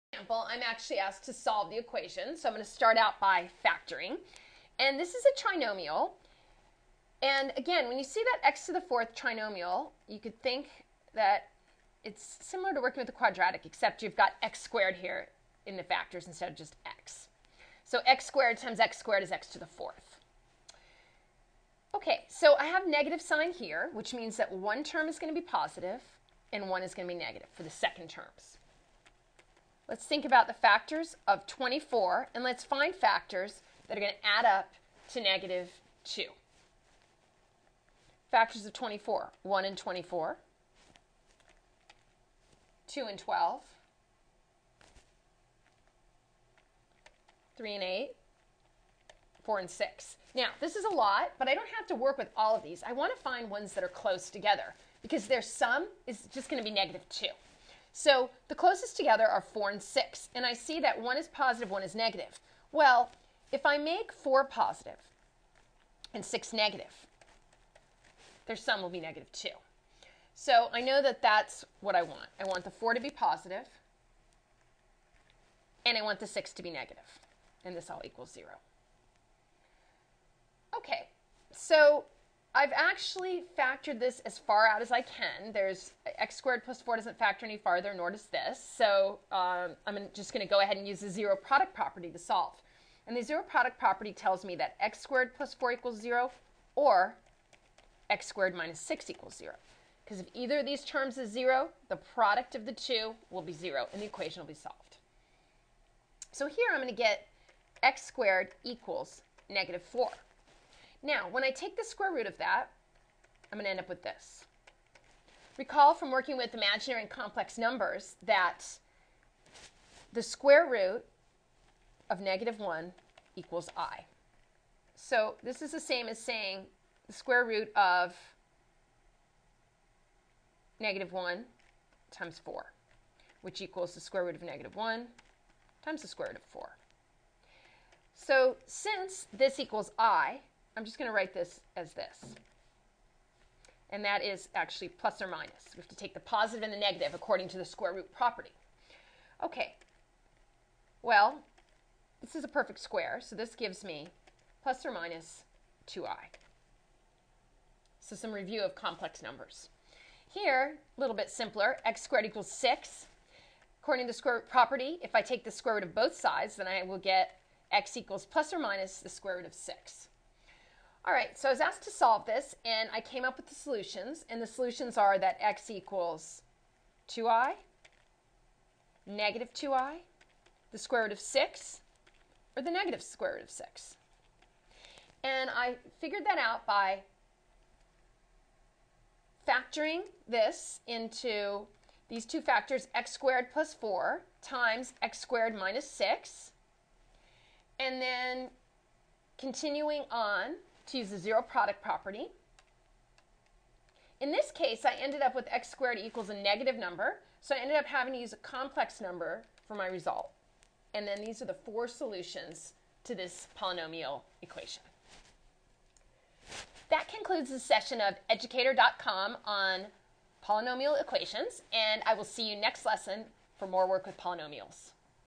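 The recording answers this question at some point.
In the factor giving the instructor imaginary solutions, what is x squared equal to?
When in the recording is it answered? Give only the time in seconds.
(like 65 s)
109 s.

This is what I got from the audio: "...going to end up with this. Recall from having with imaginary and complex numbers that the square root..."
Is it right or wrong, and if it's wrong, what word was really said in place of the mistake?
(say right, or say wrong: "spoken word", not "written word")
wrong: "working", not "having".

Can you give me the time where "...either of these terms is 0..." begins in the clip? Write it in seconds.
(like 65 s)
100 s.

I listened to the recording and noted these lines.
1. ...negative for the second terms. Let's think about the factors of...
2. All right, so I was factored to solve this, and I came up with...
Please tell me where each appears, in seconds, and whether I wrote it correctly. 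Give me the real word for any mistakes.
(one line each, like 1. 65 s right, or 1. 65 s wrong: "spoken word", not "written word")
1. 27 s right
2. 171 s wrong: "asked", not "factored".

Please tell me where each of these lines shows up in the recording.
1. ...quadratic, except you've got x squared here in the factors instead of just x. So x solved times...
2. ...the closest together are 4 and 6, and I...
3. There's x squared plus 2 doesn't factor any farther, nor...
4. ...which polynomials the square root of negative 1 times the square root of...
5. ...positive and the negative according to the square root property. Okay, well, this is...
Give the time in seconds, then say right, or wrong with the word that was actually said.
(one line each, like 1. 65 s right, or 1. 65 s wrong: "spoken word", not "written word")
1. 13 s wrong: "squared", not "solved"
2. 58 s right
3. 85 s wrong: "4", not "2"
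4. 133 s wrong: "equals", not "polynomials"
5. 146 s right.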